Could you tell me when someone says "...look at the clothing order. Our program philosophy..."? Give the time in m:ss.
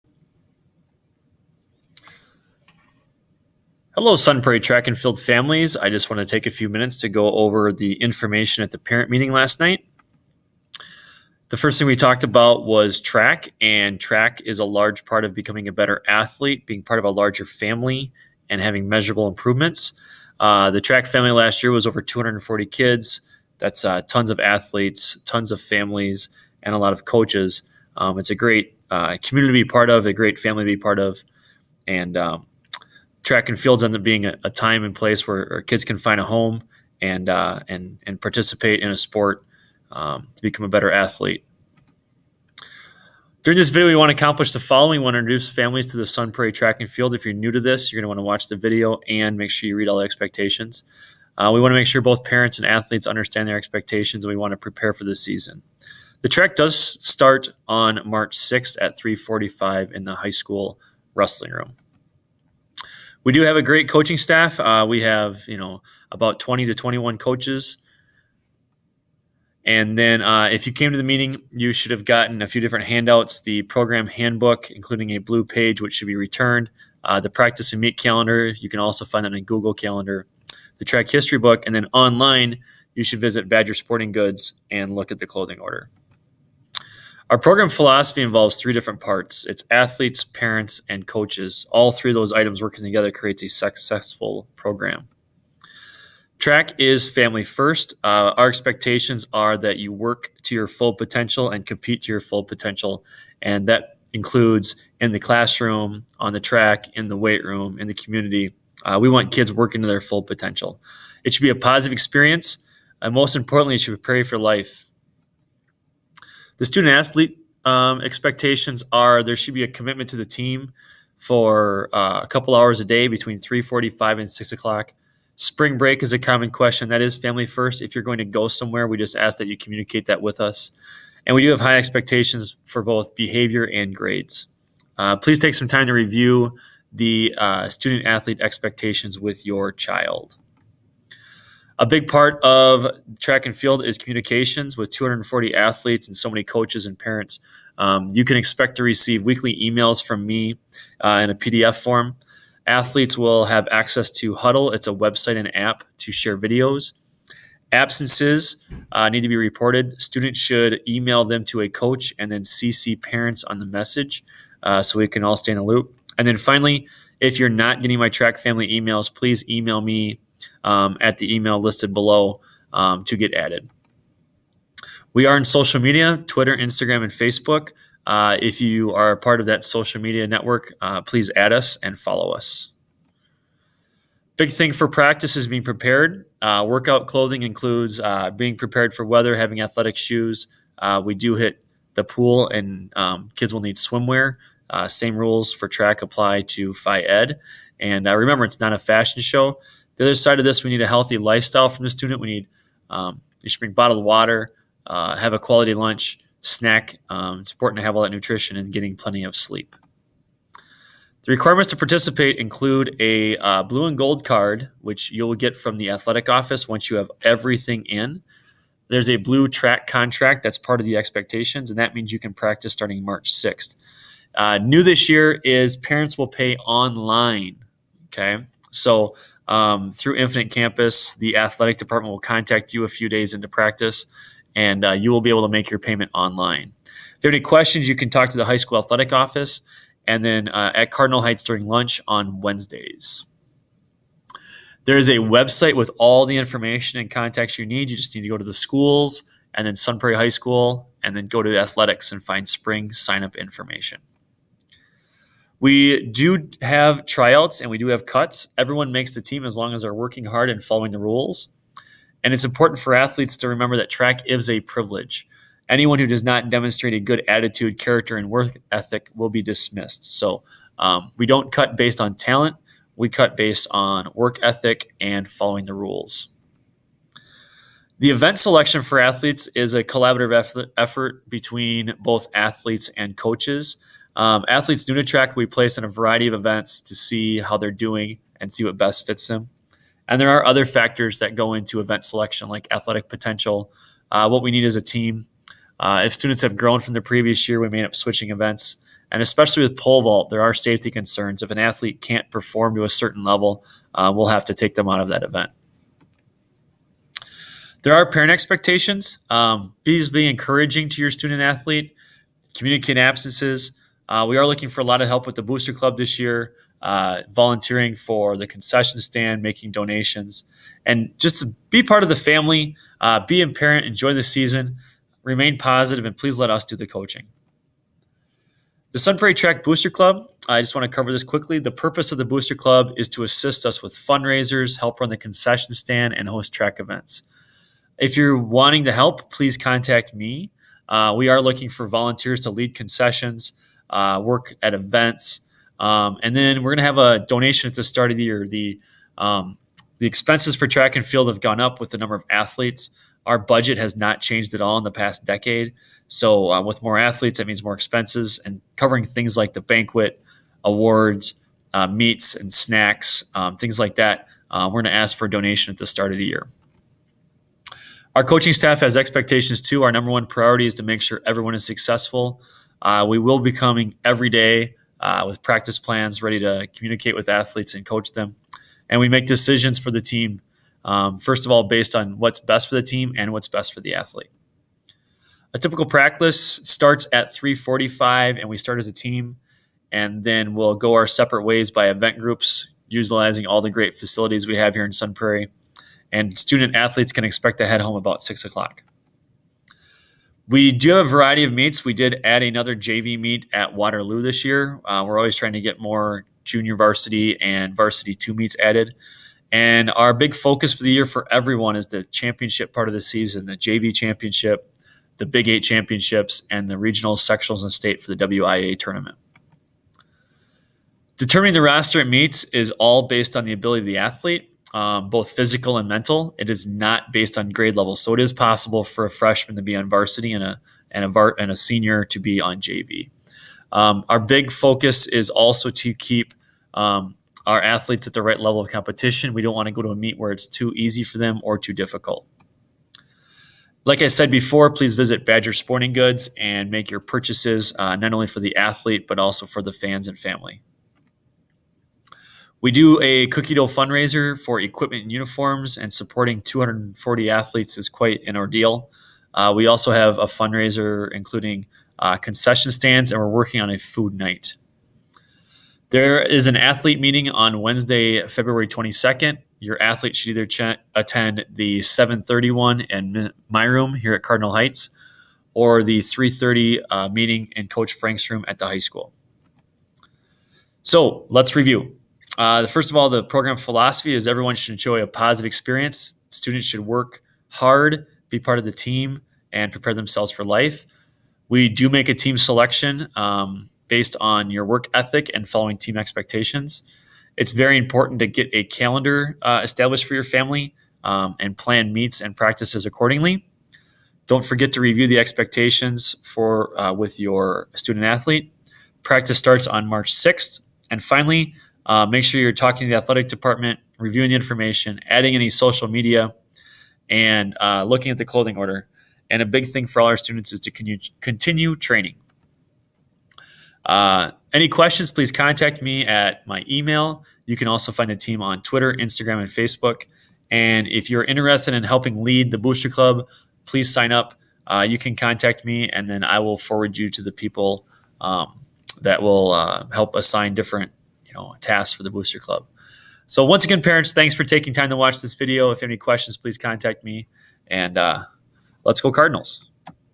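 1:24.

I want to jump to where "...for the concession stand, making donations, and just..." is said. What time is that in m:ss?
5:17.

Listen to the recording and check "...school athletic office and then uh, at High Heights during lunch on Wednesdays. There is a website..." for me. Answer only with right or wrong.
wrong.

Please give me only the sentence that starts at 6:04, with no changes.
Uh, we're going to ask for a donation at the start of the year.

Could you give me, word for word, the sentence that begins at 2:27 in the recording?
Um, you can expect to receive weekly emails from me uh, in a PDF form.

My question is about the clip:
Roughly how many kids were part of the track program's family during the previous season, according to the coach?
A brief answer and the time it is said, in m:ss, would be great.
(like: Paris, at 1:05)
over 240, at 0:21.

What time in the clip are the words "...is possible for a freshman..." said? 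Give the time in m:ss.
7:08.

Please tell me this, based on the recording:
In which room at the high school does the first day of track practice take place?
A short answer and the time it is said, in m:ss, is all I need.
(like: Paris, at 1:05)
wrestling room, at 1:01.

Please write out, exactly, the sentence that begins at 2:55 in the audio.
We are in social media Twitter, Instagram, and Facebook.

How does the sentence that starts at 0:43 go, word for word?
During this video, we want to accomplish the following.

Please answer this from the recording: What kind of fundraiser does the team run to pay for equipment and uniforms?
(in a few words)
cookie dough.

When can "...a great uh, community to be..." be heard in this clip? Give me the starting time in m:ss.
0:28.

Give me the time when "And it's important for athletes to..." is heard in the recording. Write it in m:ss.
4:22.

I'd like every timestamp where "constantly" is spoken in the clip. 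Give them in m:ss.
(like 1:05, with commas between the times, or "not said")
not said.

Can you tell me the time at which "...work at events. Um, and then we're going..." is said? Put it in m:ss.
5:44.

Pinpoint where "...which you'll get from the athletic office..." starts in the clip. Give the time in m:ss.
3:34.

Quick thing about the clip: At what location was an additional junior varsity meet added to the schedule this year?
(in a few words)
Waterloo.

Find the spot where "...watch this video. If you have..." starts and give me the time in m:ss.
9:04.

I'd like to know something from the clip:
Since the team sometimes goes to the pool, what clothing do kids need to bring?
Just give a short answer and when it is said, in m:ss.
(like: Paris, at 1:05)
swimwear, at 3:13.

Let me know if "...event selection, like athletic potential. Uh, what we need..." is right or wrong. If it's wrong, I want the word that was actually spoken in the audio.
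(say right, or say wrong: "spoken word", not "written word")
right.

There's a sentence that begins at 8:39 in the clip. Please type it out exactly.
And a big thing for all our students is to con continue training.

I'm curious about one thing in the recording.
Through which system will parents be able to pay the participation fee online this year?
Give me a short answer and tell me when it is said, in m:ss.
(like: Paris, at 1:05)
Infinite Campus, at 3:50.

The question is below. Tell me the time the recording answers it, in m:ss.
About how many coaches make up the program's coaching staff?
1:06.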